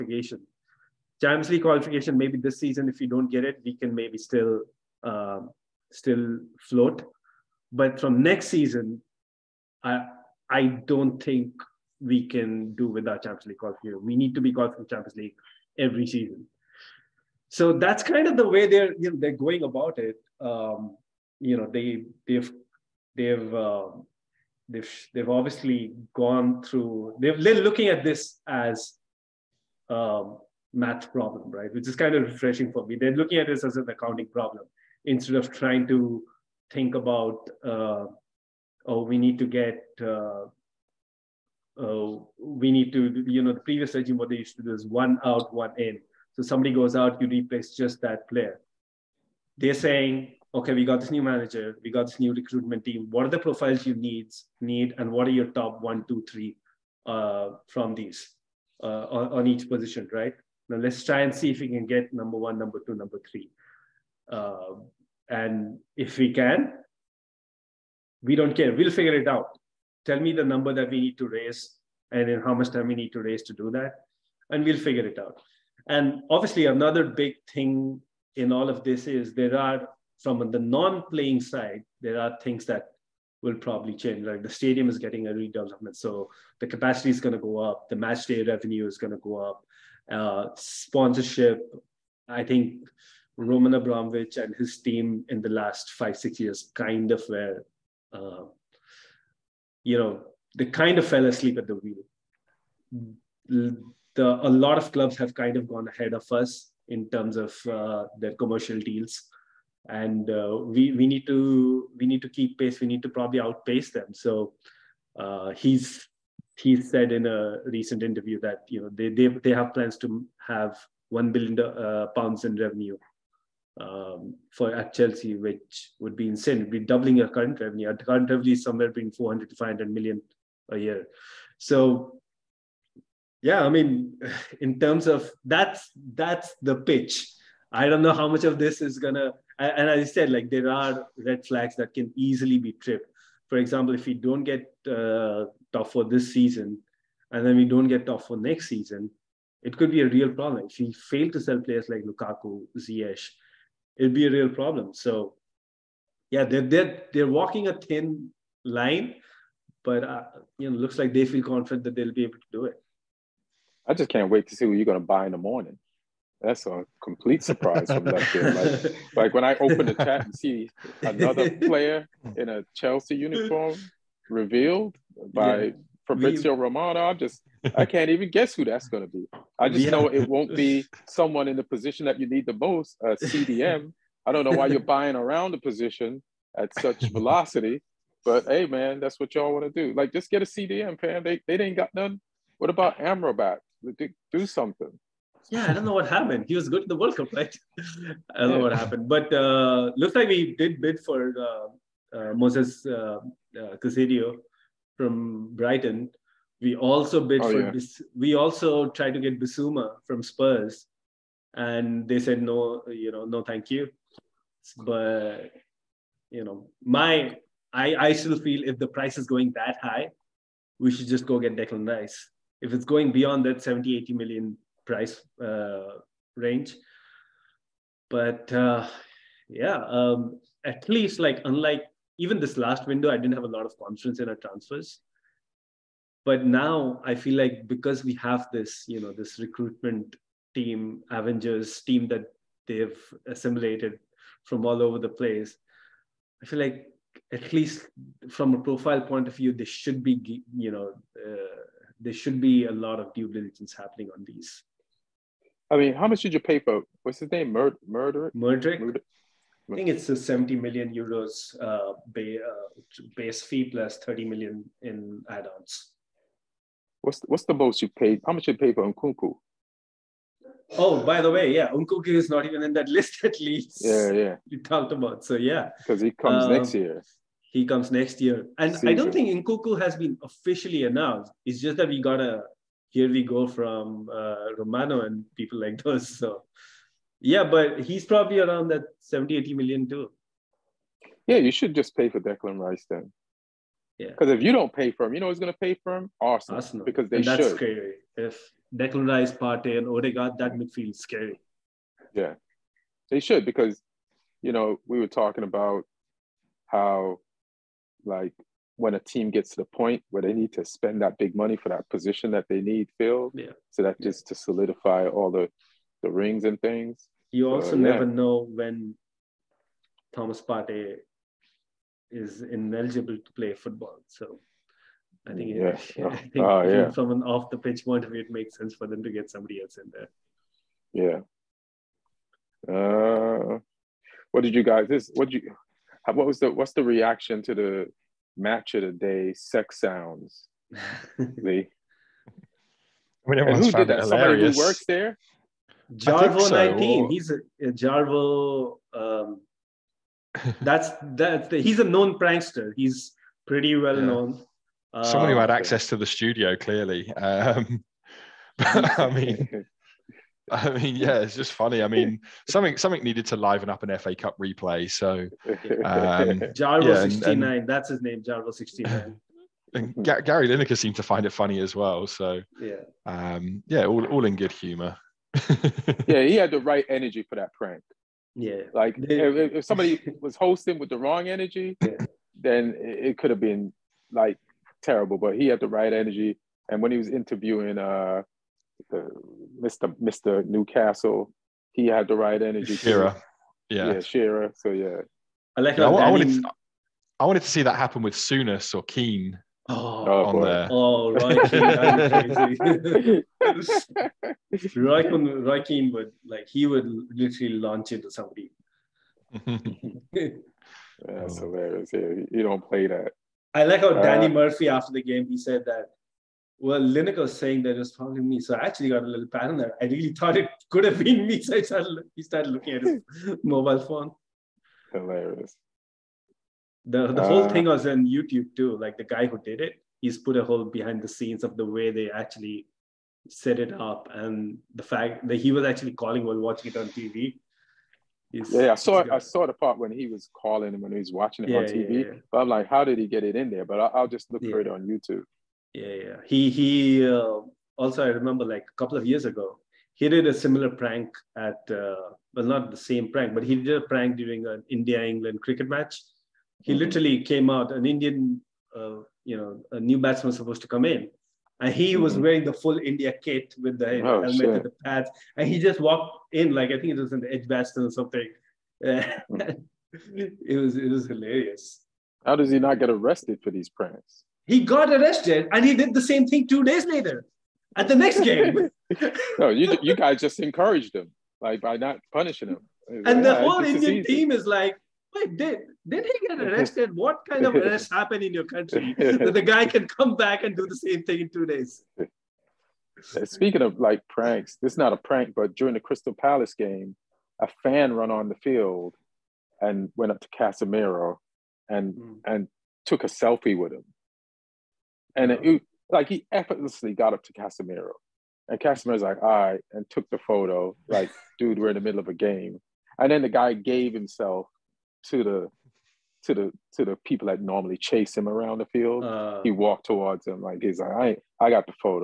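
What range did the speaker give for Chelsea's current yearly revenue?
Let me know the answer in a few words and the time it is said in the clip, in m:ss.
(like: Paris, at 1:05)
400 to 500 million, at 2:09.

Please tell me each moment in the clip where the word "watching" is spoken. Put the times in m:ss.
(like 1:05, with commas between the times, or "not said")
7:16, 7:21.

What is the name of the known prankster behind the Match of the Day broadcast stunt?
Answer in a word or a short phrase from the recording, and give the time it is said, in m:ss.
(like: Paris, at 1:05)
Jarvo 69, at 6:08.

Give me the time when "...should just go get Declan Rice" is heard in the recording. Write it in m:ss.
3:40.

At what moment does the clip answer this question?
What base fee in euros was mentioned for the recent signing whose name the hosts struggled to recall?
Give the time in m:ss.
4:20.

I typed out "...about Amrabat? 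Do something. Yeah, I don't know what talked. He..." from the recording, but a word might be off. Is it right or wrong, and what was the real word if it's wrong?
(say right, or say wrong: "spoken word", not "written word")
wrong: "happened", not "talked".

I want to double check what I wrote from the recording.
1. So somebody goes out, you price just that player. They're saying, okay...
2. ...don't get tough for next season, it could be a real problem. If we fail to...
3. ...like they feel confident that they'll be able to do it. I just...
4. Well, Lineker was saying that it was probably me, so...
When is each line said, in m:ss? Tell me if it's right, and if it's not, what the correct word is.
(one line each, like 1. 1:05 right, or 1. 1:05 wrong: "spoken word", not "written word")
1. 0:46 wrong: "replace", not "price"
2. 2:27 right
3. 2:40 right
4. 6:56 right.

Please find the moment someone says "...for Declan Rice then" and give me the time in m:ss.
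4:52.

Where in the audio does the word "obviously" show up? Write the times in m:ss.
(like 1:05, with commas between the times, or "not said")
0:25, 1:16.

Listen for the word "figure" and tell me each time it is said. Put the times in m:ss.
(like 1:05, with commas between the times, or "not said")
1:08, 1:14.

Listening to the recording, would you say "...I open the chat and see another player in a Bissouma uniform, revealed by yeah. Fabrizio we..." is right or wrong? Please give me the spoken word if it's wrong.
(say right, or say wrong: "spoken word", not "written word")
wrong: "Chelsea", not "Bissouma".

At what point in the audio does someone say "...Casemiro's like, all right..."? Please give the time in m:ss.
8:28.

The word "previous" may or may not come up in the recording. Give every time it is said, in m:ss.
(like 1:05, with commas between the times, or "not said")
0:43.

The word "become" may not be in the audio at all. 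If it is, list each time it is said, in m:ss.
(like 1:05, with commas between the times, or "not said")
not said.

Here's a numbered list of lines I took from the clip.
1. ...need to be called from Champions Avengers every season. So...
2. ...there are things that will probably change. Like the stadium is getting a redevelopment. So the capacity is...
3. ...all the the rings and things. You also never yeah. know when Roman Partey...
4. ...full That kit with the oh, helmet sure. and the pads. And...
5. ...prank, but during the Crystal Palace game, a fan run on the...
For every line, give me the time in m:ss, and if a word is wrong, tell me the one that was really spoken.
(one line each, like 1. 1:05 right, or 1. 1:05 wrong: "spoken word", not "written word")
1. 0:14 wrong: "League", not "Avengers"
2. 1:22 right
3. 5:15 wrong: "Thomas", not "Roman"
4. 7:42 wrong: "India", not "That"
5. 8:14 right.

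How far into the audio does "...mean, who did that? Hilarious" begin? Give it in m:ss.
5:43.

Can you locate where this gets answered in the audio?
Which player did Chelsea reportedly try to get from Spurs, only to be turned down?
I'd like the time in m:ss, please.
3:29.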